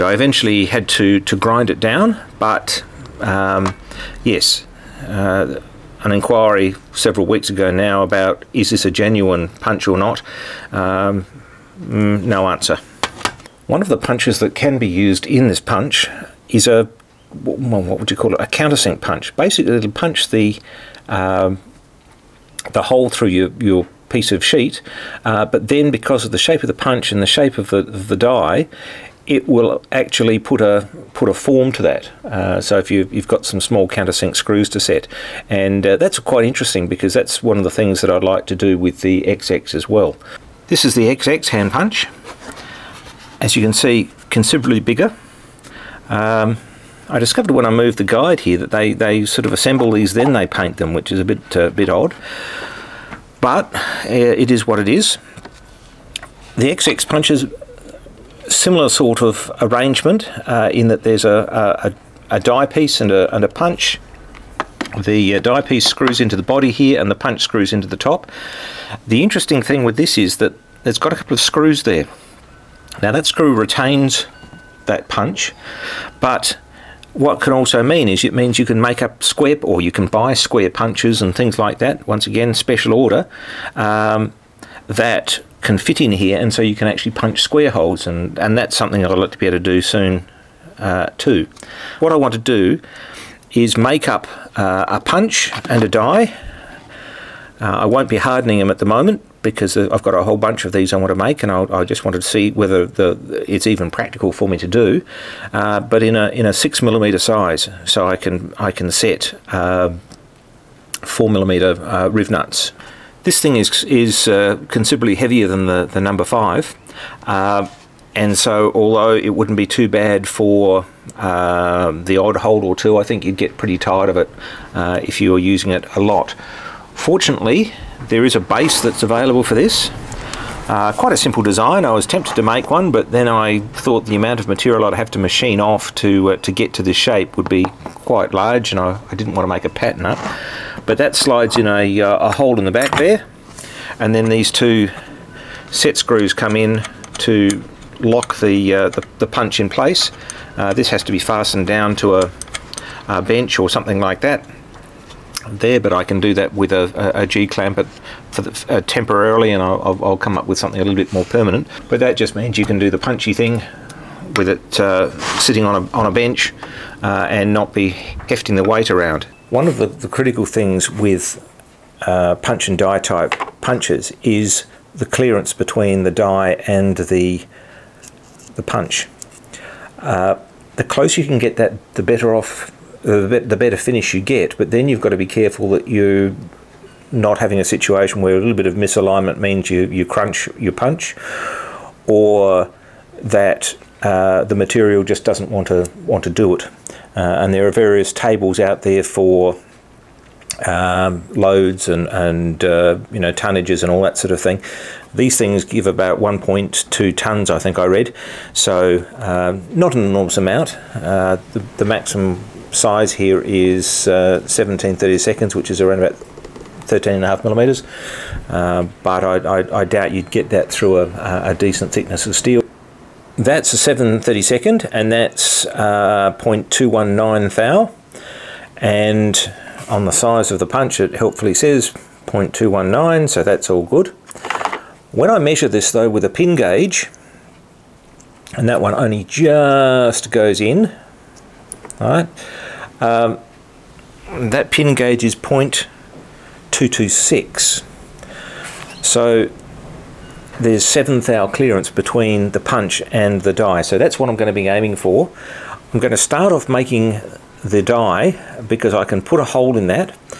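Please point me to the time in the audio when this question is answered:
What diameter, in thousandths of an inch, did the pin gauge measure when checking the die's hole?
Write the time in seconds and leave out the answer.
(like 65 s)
245 s.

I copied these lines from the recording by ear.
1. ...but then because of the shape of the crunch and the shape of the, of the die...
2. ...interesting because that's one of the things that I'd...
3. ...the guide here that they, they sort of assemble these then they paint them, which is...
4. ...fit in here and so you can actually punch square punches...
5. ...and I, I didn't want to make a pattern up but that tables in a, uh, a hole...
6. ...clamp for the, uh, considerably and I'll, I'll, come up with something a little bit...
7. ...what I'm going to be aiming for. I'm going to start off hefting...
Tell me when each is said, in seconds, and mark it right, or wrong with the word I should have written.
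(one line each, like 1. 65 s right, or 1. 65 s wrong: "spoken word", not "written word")
1. 25 s wrong: "punch", not "crunch"
2. 36 s right
3. 47 s right
4. 85 s wrong: "holes", not "punches"
5. 138 s wrong: "slides", not "tables"
6. 157 s wrong: "temporarily", not "considerably"
7. 254 s wrong: "making", not "hefting".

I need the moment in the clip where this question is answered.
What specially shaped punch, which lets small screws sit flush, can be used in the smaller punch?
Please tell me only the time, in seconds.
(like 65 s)
18 s.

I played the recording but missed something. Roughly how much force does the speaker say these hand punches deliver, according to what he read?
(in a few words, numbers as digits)
1.2 tons.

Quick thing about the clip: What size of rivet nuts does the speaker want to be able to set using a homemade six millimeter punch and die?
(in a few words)
4 millimeter.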